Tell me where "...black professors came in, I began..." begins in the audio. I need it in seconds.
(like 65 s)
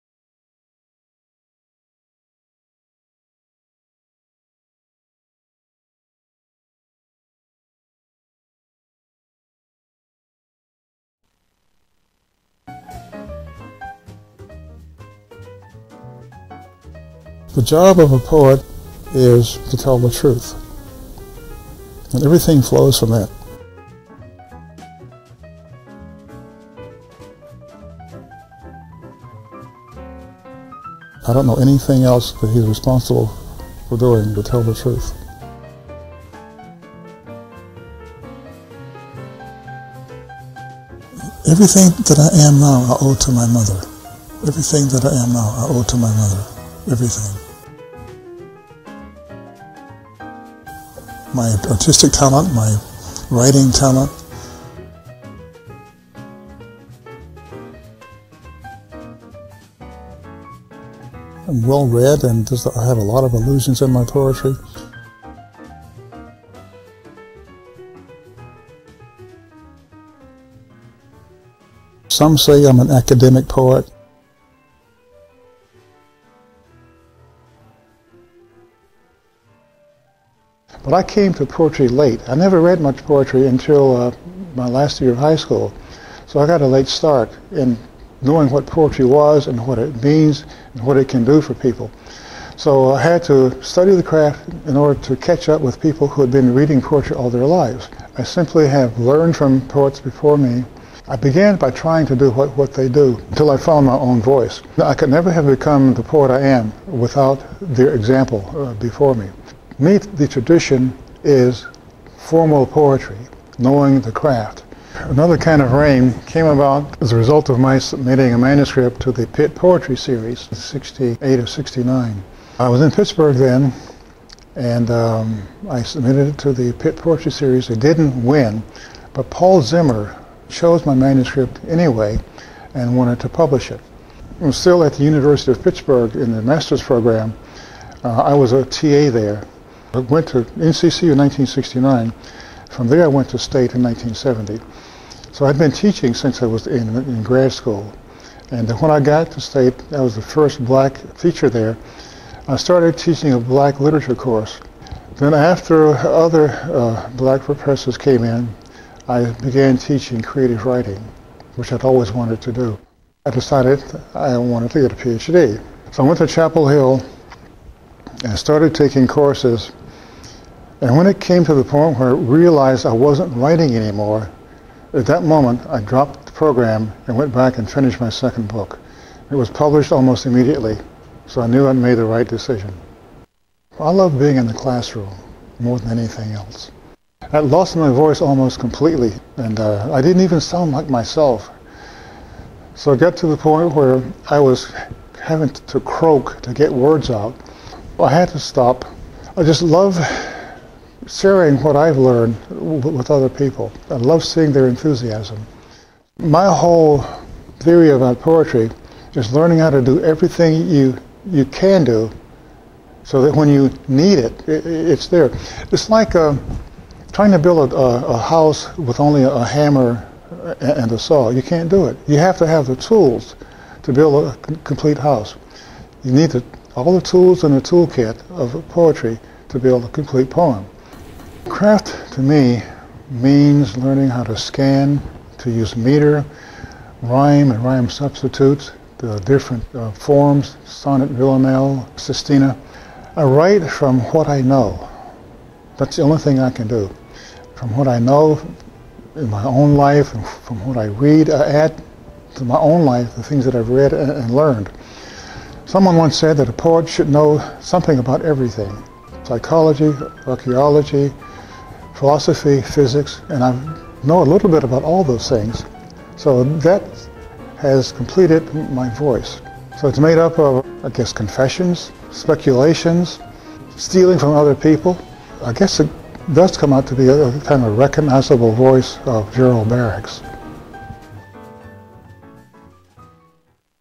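157 s.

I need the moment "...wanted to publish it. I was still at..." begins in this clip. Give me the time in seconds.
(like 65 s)
132 s.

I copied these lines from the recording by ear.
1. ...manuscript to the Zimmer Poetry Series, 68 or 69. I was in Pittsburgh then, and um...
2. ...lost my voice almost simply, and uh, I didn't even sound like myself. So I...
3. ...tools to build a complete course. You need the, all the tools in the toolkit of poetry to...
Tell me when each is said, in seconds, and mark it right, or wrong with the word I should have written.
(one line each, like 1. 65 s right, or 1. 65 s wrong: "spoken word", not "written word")
1. 118 s wrong: "Pitt", not "Zimmer"
2. 187 s wrong: "completely", not "simply"
3. 222 s wrong: "house", not "course".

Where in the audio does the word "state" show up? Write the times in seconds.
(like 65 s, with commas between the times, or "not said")
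143 s, 149 s.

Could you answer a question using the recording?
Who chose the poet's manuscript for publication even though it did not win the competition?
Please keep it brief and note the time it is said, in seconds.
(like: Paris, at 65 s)
Paul Zimmer, at 129 s.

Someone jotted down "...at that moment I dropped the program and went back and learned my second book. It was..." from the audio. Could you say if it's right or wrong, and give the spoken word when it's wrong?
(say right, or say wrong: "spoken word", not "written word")
wrong: "finished", not "learned".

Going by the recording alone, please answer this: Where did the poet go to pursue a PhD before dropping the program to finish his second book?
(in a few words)
Chapel Hill.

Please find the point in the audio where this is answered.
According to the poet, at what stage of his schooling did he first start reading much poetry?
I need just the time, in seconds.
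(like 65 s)
84 s.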